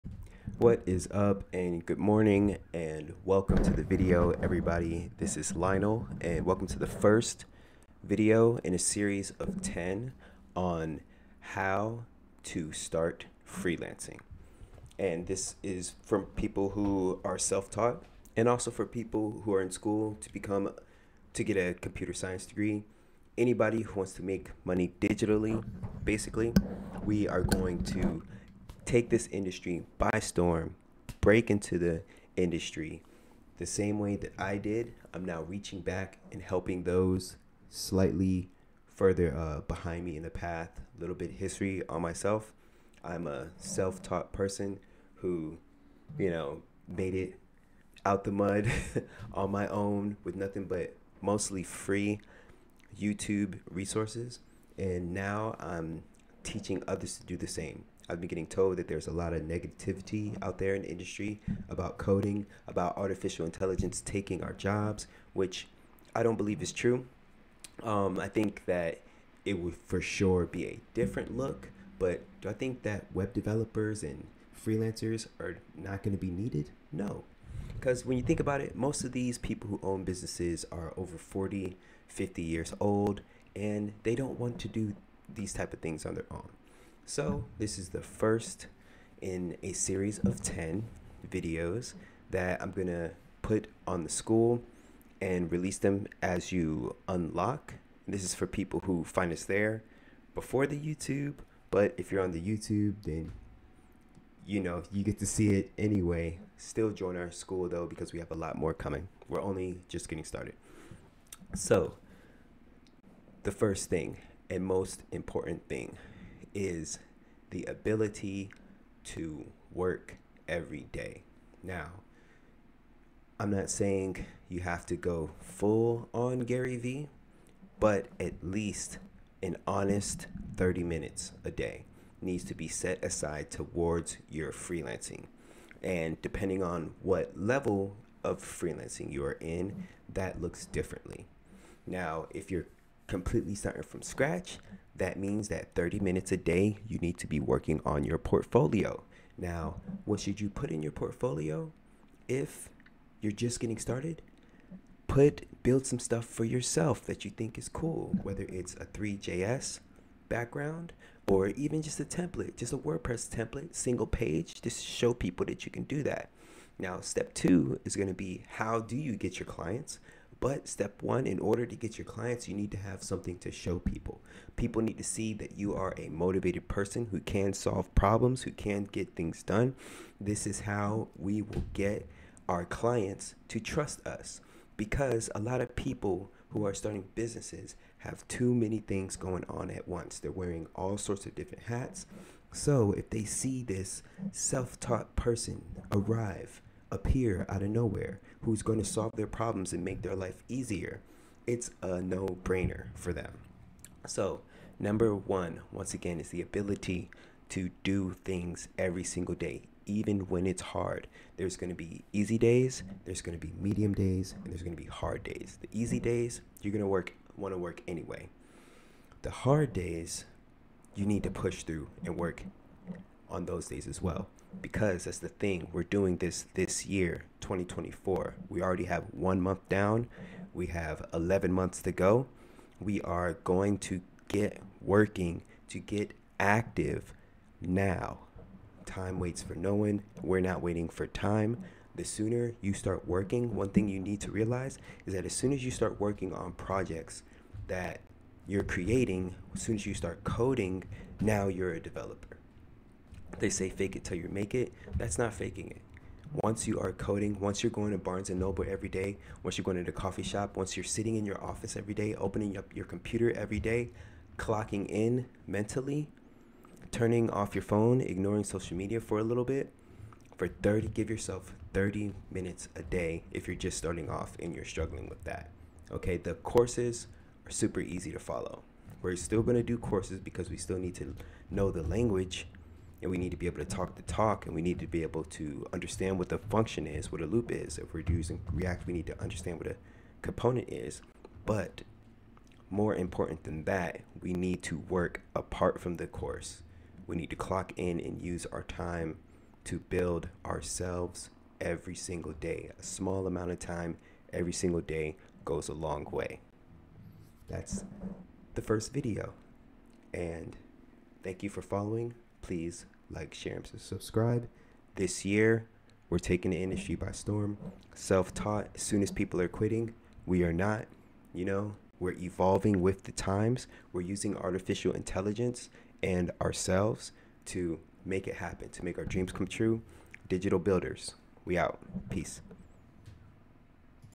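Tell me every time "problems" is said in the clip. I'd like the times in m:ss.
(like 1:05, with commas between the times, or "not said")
2:57, 3:19.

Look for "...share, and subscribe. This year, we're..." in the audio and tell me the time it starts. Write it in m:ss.
5:13.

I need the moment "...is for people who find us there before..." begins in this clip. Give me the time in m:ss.
1:38.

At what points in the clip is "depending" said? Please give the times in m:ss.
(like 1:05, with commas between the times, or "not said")
2:16.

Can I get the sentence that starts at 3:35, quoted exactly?
The easy days, you're going to work want to work anyway.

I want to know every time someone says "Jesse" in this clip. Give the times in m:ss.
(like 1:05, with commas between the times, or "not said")
not said.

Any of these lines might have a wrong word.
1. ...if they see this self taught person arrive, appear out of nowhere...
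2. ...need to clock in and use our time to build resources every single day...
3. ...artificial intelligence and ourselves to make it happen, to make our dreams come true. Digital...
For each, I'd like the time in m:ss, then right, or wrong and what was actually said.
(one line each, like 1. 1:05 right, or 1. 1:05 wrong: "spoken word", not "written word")
1. 3:12 right
2. 4:57 wrong: "ourselves", not "resources"
3. 5:24 right.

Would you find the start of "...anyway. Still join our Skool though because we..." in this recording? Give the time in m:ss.
1:45.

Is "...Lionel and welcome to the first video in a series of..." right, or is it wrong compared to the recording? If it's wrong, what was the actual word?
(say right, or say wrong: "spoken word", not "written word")
right.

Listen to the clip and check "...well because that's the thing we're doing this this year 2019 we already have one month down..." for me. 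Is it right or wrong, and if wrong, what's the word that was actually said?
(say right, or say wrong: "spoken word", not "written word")
wrong: "2024", not "2019".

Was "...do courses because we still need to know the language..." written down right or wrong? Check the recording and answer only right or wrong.
right.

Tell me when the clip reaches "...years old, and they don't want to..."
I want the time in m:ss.
1:22.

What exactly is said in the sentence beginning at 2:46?
Now, step 2 is going to be how do you get your clients?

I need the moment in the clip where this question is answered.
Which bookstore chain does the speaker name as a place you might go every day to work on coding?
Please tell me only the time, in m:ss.
4:17.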